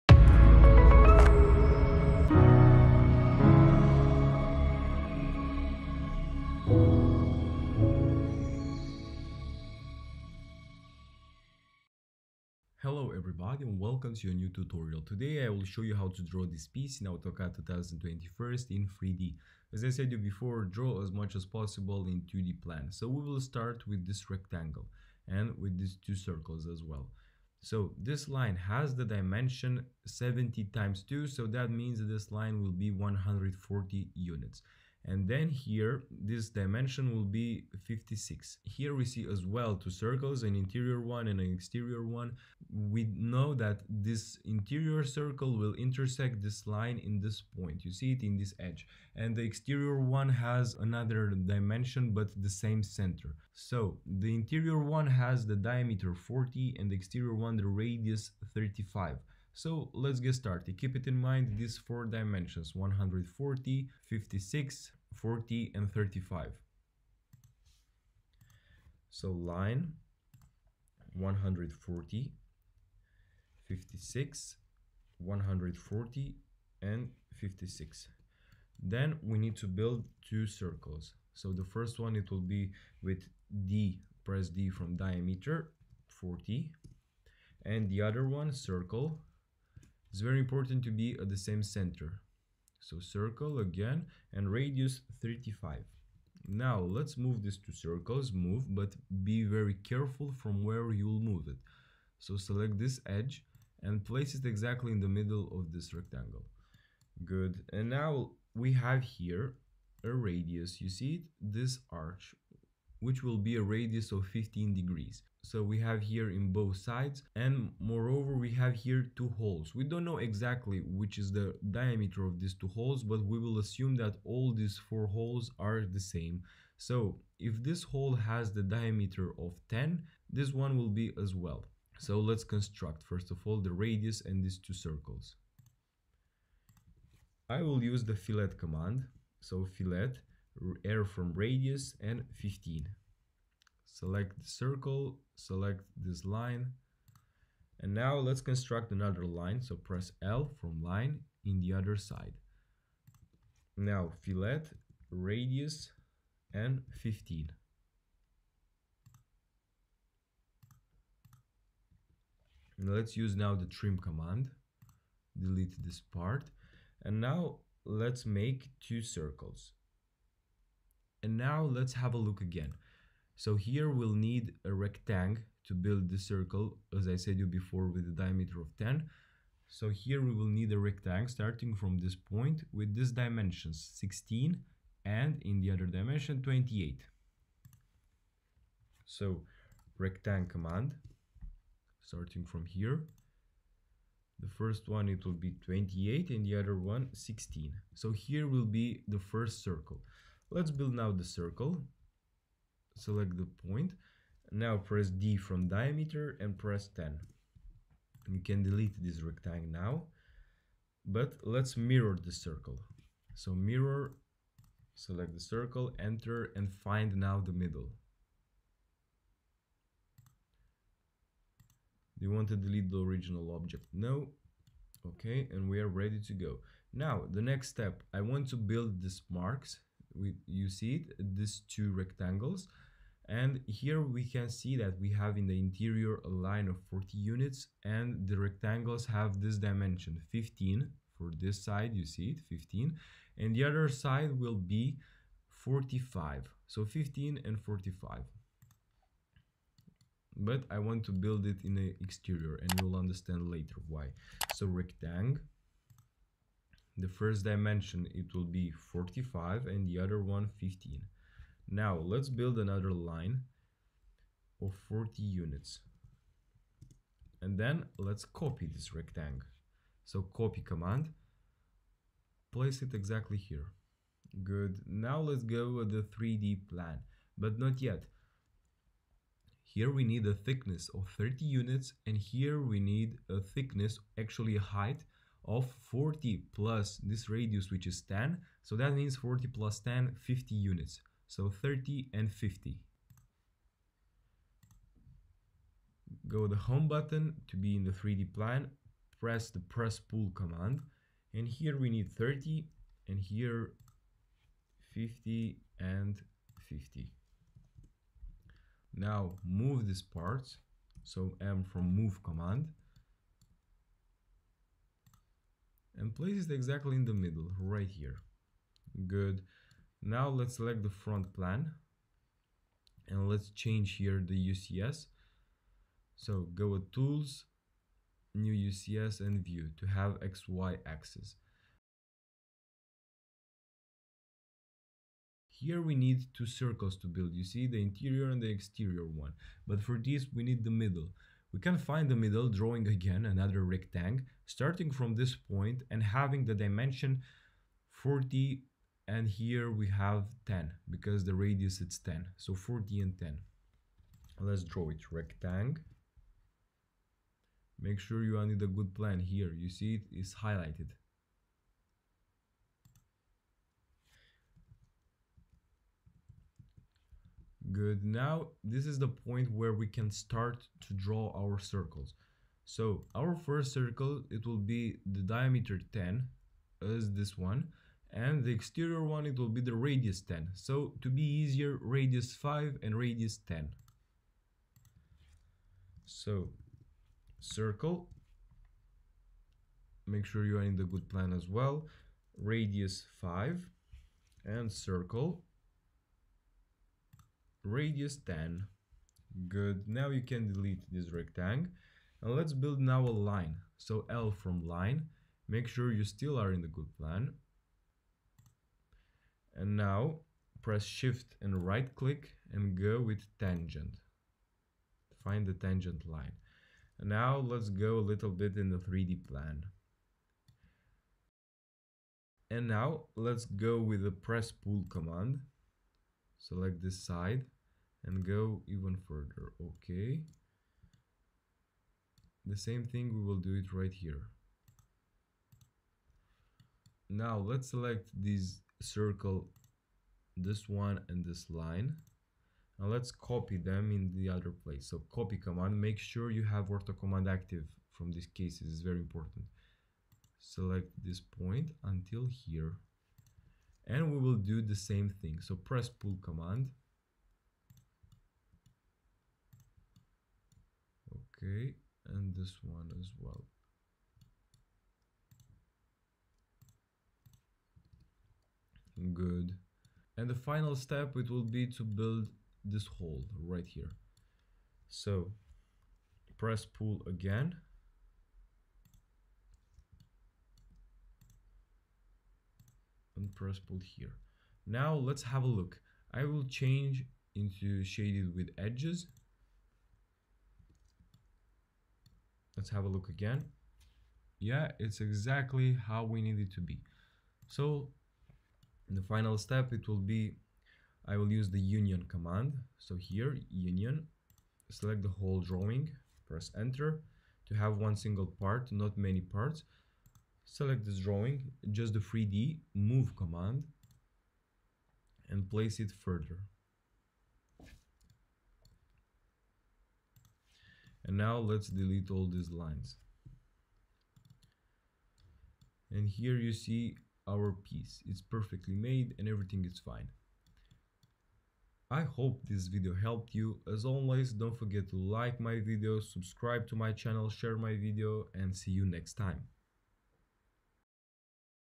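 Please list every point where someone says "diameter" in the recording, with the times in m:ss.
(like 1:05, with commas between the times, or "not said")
0:55, 1:24, 2:01, 2:08, 2:58, 3:25, 6:15.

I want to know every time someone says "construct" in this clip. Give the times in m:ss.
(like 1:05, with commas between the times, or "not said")
2:12, 2:28.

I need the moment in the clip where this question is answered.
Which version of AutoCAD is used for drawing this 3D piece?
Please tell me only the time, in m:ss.
0:17.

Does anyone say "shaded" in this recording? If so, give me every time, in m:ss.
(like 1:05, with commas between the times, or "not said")
8:07.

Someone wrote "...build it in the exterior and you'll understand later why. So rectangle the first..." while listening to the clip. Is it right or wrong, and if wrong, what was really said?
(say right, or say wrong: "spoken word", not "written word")
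right.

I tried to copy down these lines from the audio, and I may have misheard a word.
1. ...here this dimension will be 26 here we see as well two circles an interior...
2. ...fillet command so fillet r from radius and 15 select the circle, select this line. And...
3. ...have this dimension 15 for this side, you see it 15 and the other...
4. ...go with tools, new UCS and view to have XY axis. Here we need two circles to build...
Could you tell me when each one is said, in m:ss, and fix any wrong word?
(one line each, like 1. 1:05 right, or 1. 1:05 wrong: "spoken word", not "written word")
1. 0:35 wrong: "56", not "26"
2. 2:18 right
3. 3:59 right
4. 5:26 right.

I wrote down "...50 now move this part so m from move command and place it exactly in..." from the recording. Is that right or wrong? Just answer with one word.
right.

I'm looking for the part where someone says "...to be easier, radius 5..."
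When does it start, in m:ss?
6:21.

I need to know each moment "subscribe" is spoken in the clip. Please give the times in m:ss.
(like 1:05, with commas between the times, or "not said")
8:55.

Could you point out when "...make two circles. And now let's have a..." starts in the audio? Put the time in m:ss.
2:48.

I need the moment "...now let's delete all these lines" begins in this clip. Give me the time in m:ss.
8:41.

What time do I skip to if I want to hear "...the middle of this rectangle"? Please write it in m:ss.
1:44.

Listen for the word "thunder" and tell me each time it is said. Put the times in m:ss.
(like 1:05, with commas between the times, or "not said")
not said.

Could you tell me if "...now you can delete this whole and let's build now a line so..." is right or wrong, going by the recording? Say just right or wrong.
wrong.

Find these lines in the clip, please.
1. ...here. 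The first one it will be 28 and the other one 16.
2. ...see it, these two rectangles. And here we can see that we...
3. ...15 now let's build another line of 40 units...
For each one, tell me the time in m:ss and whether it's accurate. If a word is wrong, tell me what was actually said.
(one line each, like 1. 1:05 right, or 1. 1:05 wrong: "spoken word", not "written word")
1. 3:12 right
2. 3:50 right
3. 4:20 right.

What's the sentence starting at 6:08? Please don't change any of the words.
Now, this is the point where we can start to draw our circles.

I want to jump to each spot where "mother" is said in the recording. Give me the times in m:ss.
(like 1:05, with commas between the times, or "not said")
not said.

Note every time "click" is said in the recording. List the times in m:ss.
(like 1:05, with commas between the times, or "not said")
6:51.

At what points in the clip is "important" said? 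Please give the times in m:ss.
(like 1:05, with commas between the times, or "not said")
1:30, 7:29.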